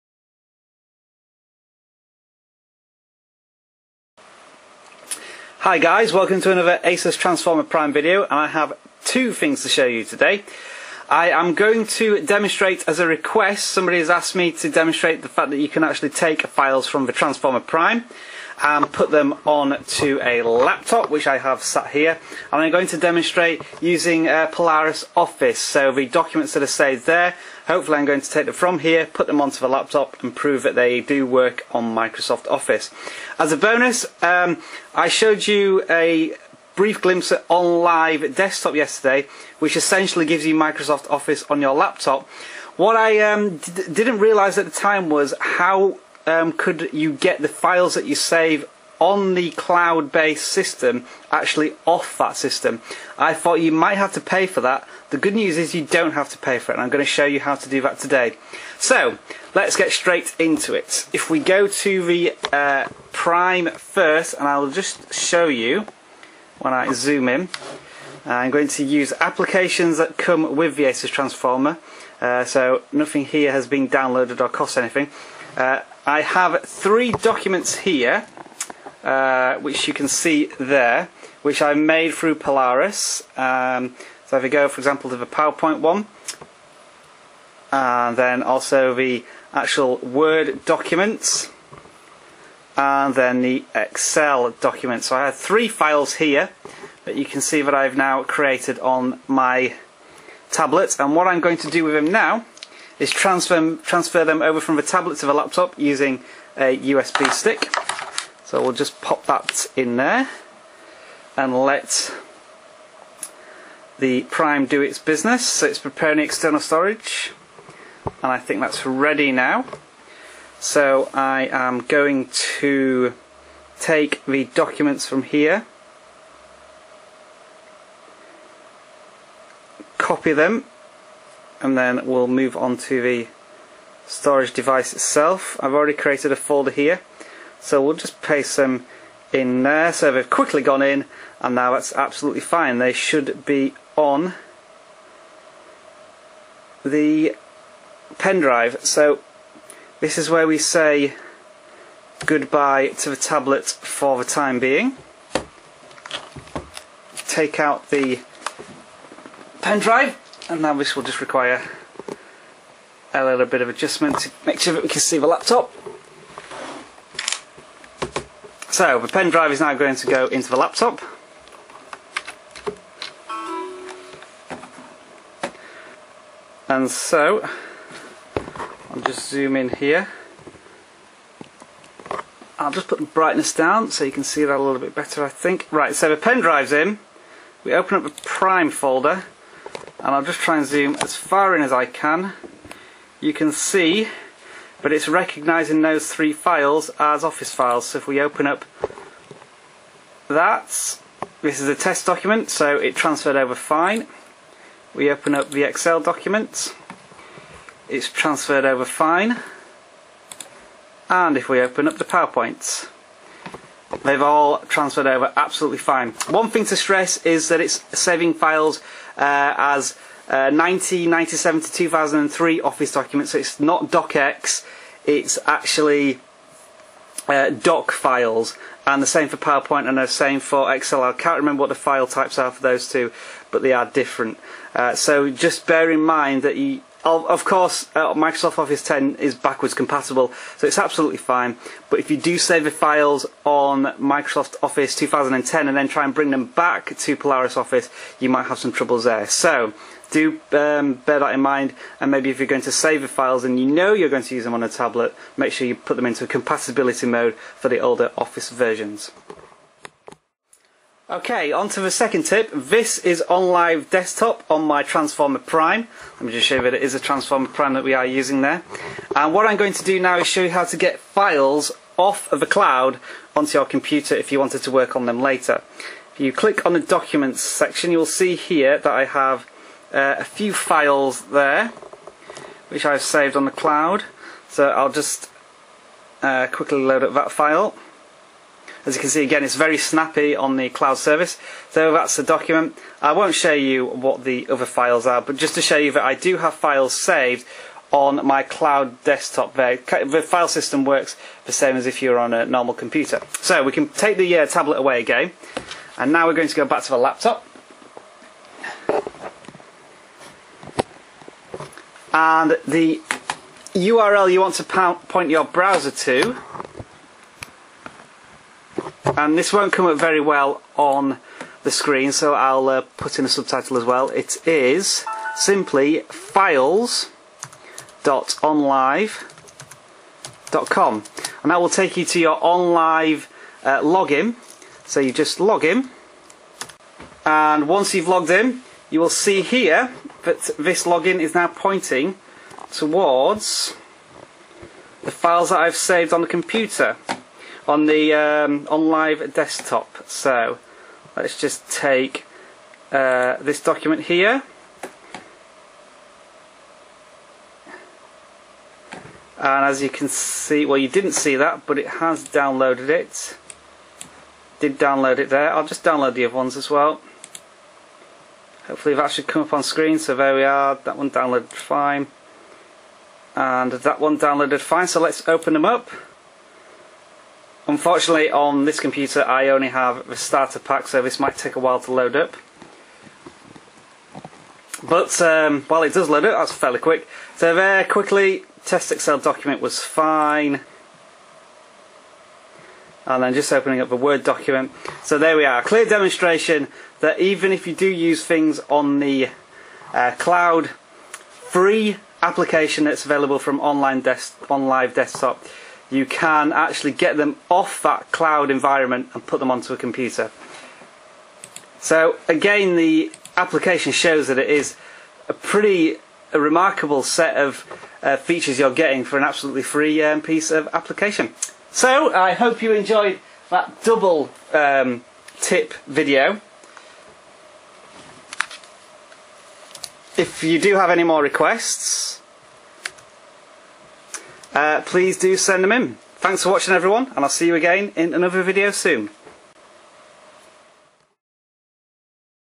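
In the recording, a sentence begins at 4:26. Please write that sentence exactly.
Let me just show you that it is a Transformer Prime that we are using there.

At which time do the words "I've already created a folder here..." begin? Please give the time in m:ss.
2:15.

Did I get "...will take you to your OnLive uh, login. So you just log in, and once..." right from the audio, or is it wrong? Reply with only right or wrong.
right.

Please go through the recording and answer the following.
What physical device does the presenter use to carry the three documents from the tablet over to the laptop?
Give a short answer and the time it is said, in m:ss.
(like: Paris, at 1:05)
USB stick, at 1:46.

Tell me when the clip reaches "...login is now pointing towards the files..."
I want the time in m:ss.
5:40.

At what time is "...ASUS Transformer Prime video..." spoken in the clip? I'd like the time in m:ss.
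0:06.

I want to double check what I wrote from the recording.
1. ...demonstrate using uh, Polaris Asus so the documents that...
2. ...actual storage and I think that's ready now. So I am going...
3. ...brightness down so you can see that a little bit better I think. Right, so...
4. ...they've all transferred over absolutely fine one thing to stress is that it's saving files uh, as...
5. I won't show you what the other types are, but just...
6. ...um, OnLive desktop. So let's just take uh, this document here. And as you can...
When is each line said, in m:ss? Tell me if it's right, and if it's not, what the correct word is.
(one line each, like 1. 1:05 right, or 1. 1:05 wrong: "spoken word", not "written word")
1. 0:22 wrong: "Office", not "Asus"
2. 1:56 wrong: "external", not "actual"
3. 3:03 right
4. 3:34 right
5. 4:53 wrong: "files", not "types"
6. 5:48 right.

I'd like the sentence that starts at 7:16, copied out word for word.
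Thanks for watching everyone and I'll see you again in another video soon.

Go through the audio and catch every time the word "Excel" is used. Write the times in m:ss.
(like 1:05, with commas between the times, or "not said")
1:33, 3:25, 3:50, 6:28.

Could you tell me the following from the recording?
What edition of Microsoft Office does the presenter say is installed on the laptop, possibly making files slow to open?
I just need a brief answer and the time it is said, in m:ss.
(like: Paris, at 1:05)
starter pack, at 6:20.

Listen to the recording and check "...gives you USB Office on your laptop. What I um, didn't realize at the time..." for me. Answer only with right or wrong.
wrong.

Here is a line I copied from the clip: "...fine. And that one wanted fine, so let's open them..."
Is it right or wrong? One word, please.
wrong.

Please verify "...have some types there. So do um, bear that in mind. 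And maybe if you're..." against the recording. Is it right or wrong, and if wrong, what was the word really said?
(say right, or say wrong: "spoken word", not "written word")
wrong: "troubles", not "types".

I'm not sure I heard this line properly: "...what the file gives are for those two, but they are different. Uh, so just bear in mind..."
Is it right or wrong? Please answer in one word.
wrong.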